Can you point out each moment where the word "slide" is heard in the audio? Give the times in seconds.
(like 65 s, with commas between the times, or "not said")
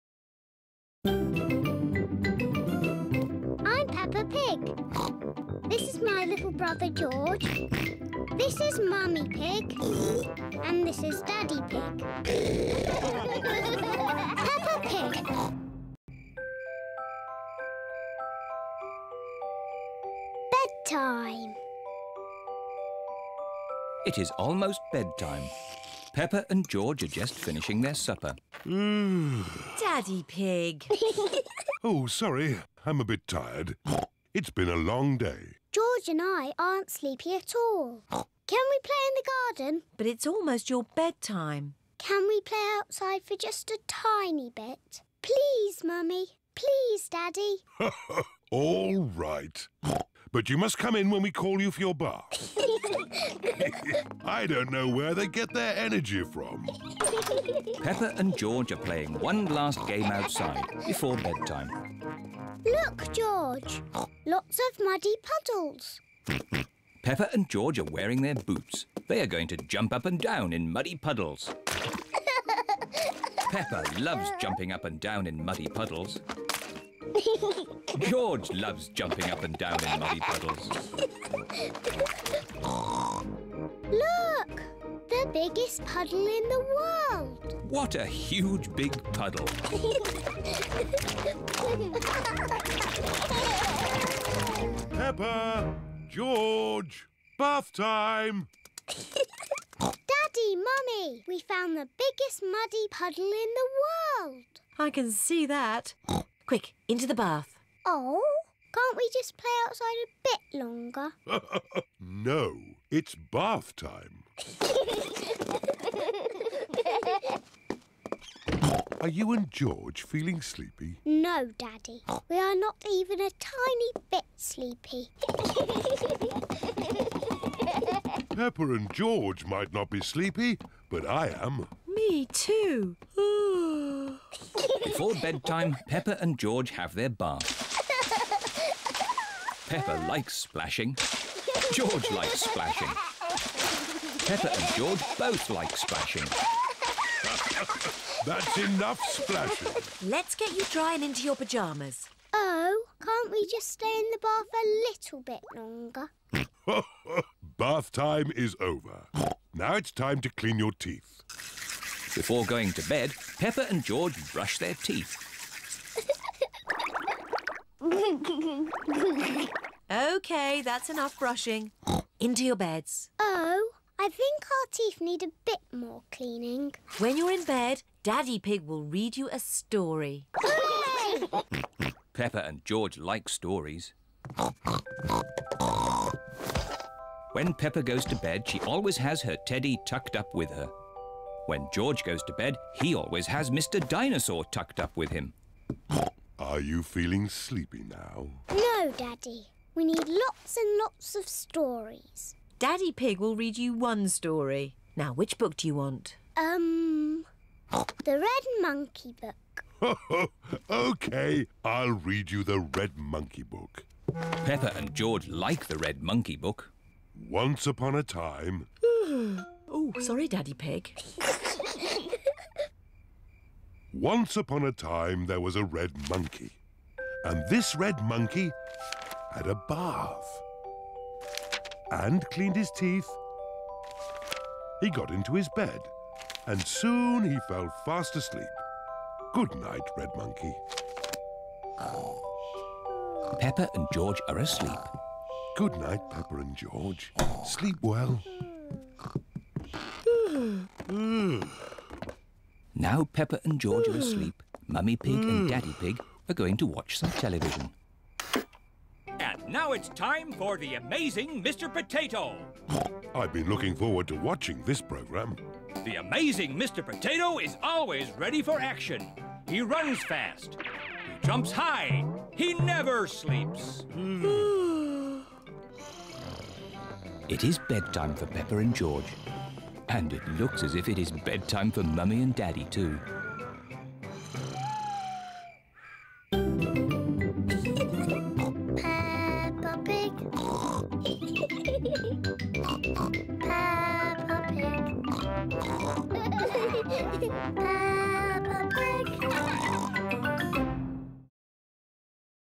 not said.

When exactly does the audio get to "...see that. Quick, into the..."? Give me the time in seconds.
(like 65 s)
105 s.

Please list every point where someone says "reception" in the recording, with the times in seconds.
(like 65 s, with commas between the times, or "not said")
not said.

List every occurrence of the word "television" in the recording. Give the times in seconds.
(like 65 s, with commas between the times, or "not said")
257 s.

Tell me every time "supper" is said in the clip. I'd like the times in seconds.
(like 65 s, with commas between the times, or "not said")
27 s.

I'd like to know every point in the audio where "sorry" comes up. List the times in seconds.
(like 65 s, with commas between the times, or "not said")
32 s, 220 s.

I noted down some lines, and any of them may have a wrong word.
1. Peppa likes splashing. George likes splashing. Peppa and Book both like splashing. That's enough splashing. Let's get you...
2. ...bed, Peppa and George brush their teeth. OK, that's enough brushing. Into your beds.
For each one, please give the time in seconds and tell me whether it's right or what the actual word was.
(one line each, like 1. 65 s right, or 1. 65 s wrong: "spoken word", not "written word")
1. 139 s wrong: "George", not "Book"
2. 162 s right.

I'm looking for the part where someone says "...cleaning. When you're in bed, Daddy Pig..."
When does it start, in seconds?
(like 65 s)
176 s.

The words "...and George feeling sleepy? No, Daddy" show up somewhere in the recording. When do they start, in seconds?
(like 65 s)
119 s.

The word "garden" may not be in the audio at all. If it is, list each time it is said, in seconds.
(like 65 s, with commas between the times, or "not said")
39 s.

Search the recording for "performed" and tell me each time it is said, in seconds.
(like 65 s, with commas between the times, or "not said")
not said.